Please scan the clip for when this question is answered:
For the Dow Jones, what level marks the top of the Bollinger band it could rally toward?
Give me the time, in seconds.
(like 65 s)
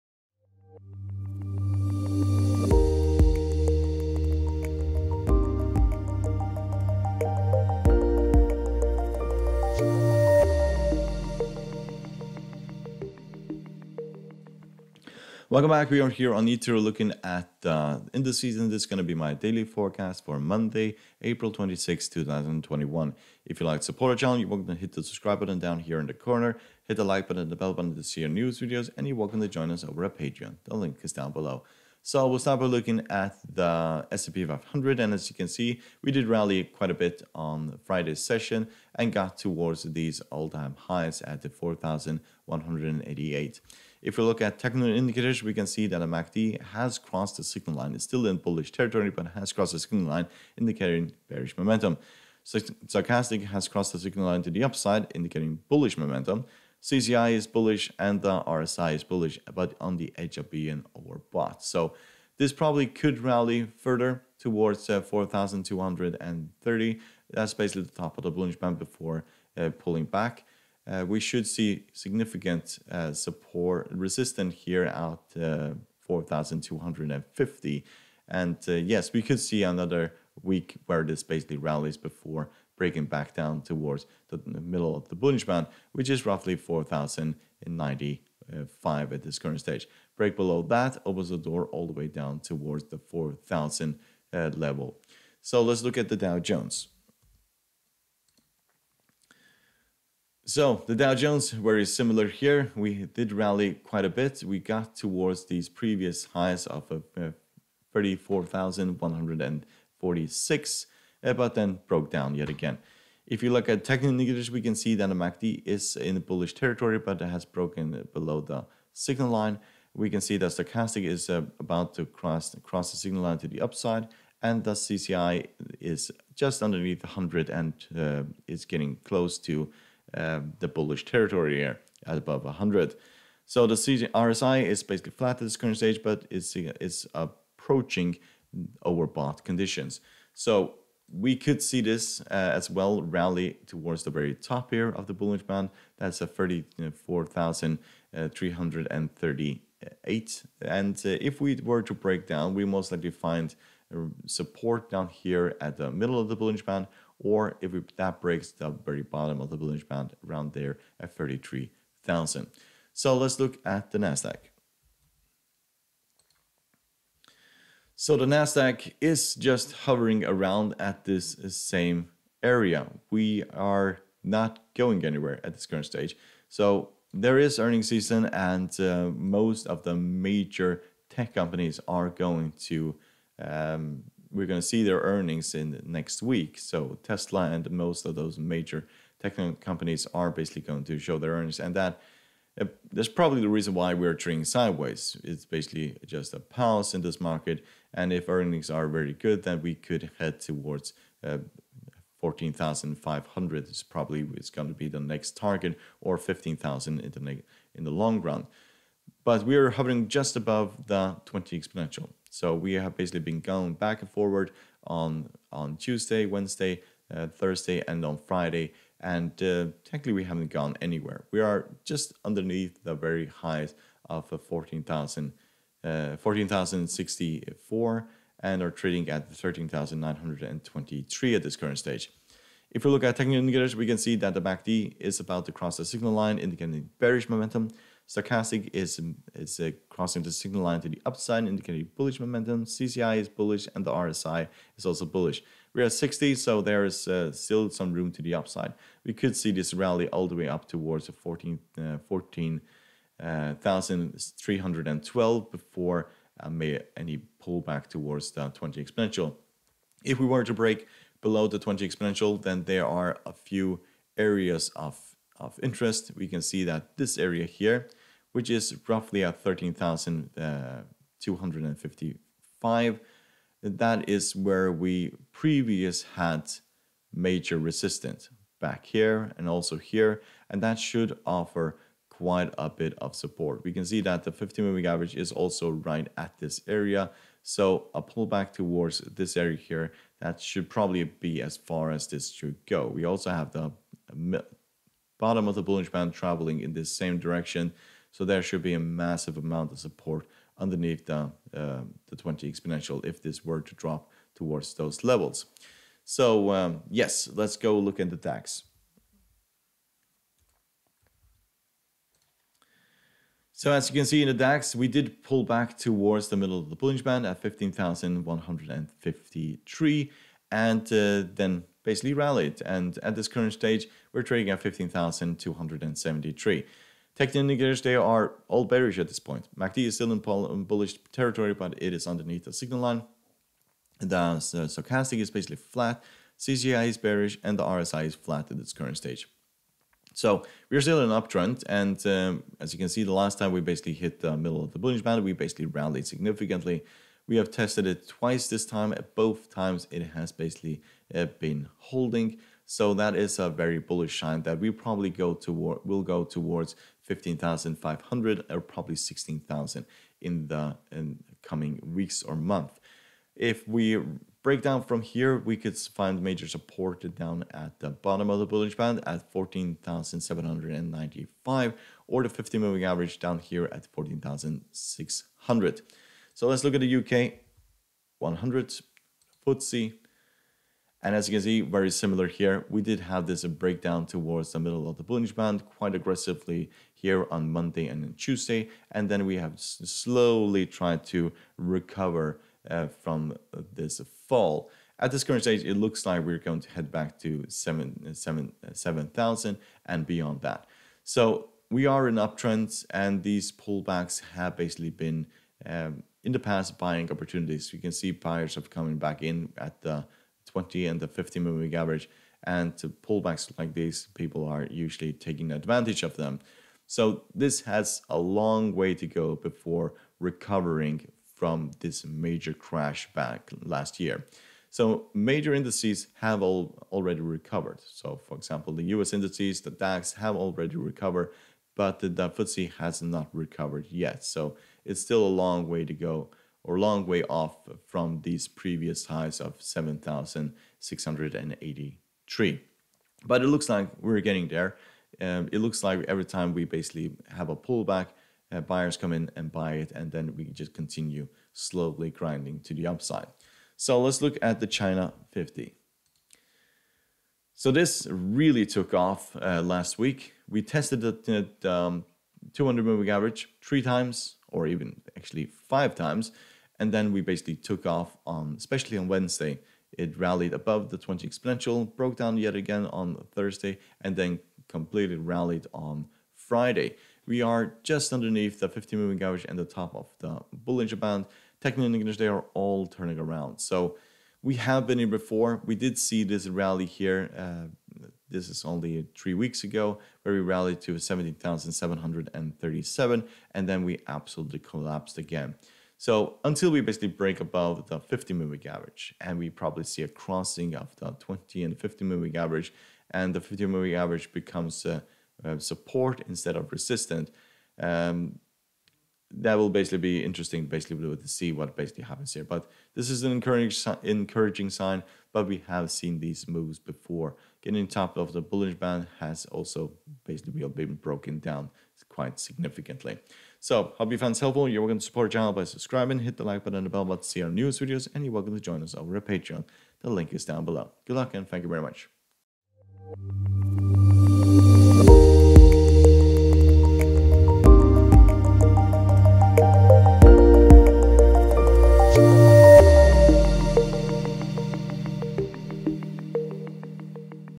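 146 s.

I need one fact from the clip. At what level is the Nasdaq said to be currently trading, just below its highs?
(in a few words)
13,923.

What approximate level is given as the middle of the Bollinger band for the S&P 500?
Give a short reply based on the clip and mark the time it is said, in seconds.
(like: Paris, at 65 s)
4,095, at 86 s.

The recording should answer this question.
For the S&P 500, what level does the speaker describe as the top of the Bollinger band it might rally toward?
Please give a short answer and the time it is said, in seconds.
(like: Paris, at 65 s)
4,230, at 65 s.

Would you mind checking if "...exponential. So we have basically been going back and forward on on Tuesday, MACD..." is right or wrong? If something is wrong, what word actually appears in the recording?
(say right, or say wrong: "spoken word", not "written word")
wrong: "Wednesday", not "MACD".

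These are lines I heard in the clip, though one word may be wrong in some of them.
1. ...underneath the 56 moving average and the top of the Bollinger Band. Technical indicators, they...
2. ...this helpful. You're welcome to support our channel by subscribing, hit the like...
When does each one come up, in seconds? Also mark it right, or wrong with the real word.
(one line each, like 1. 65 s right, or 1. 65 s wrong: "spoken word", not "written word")
1. 478 s wrong: "50", not "56"
2. 524 s right.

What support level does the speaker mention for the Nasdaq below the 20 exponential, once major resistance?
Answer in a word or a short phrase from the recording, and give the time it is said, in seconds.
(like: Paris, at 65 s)
13,255, at 269 s.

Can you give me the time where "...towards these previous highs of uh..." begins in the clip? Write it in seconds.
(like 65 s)
104 s.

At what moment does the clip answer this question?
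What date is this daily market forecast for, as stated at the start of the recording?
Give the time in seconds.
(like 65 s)
20 s.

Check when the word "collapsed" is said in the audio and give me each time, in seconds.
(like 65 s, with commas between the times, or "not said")
494 s.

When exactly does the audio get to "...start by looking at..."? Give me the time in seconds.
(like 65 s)
32 s.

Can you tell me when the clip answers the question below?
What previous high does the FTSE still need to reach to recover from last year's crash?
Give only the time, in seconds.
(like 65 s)
439 s.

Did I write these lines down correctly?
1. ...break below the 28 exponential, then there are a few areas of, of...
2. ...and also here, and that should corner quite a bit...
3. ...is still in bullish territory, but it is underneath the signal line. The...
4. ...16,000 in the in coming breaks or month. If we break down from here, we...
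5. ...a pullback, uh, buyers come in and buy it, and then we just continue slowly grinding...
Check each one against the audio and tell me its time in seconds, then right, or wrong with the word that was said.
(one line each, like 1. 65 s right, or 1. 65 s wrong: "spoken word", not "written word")
1. 260 s wrong: "20", not "28"
2. 279 s wrong: "offer", not "corner"
3. 329 s right
4. 358 s wrong: "weeks", not "breaks"
5. 447 s right.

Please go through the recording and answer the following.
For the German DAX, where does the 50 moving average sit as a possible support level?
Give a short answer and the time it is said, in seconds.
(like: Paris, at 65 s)
14,600, at 373 s.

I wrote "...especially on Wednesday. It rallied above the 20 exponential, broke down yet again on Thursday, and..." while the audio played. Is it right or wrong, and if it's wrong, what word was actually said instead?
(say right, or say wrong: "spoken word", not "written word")
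right.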